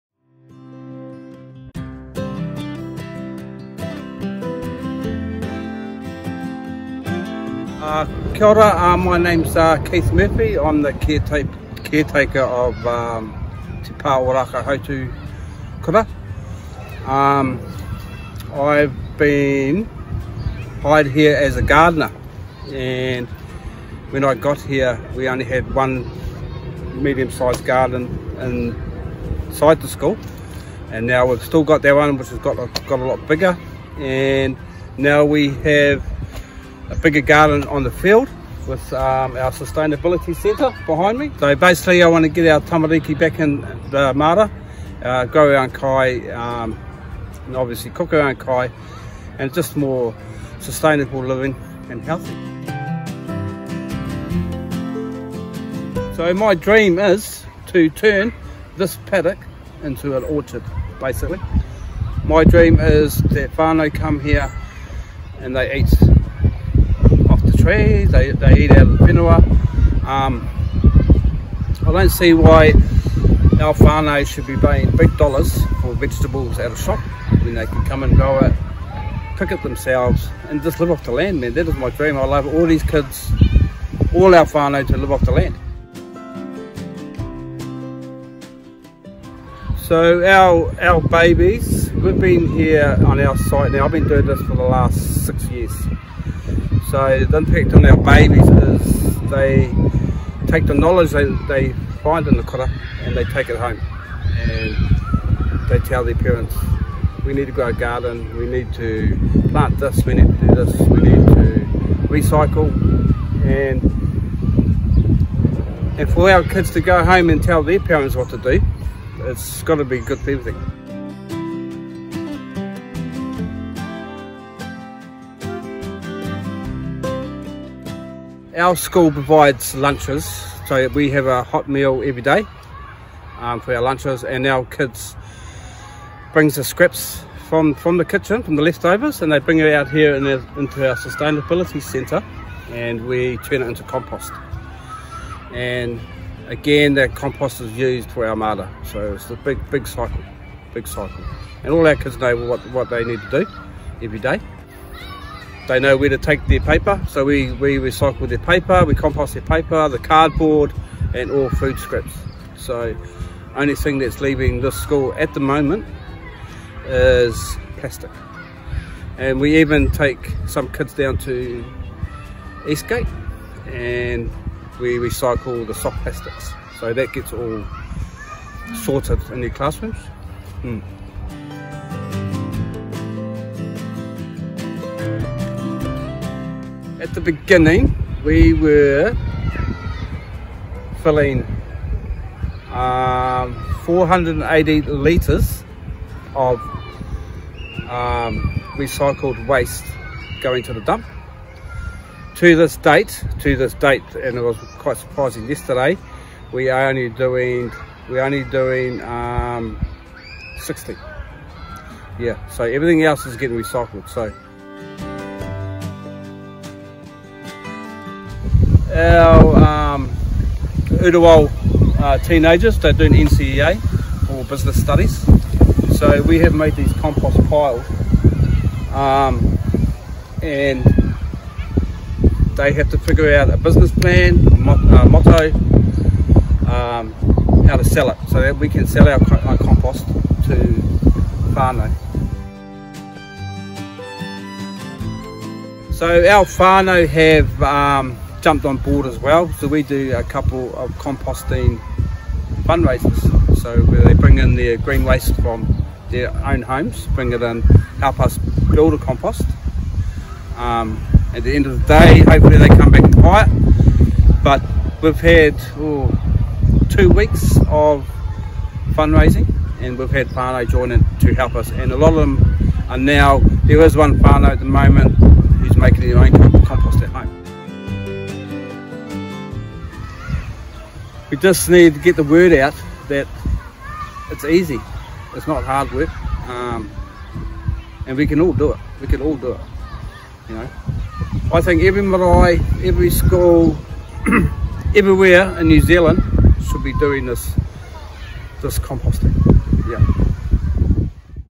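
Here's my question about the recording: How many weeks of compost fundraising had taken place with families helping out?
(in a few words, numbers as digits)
2.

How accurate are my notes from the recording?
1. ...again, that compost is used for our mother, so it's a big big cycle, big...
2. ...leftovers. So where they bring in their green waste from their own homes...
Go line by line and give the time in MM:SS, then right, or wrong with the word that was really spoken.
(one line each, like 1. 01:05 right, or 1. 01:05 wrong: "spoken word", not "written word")
1. 02:26 right
2. 04:12 wrong: "fundraisers", not "leftovers".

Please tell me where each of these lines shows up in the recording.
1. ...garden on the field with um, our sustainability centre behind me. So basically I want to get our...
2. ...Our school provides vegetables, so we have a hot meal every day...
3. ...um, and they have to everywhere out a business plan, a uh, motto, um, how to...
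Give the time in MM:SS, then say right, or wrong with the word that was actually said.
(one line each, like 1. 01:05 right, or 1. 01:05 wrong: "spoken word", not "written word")
1. 00:37 right
2. 02:08 wrong: "lunches", not "vegetables"
3. 03:48 wrong: "figure", not "everywhere".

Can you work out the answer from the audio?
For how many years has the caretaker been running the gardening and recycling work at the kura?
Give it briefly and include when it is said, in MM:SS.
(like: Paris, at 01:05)
6, at 01:35.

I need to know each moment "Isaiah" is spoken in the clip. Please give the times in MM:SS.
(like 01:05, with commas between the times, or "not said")
not said.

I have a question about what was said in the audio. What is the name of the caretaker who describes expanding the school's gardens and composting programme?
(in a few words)
Keith Murphy.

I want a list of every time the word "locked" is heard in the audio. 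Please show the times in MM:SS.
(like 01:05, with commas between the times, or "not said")
not said.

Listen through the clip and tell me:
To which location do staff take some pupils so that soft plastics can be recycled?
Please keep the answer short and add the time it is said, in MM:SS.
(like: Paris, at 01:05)
Eastgate, at 02:52.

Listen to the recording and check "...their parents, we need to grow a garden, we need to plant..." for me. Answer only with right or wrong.
right.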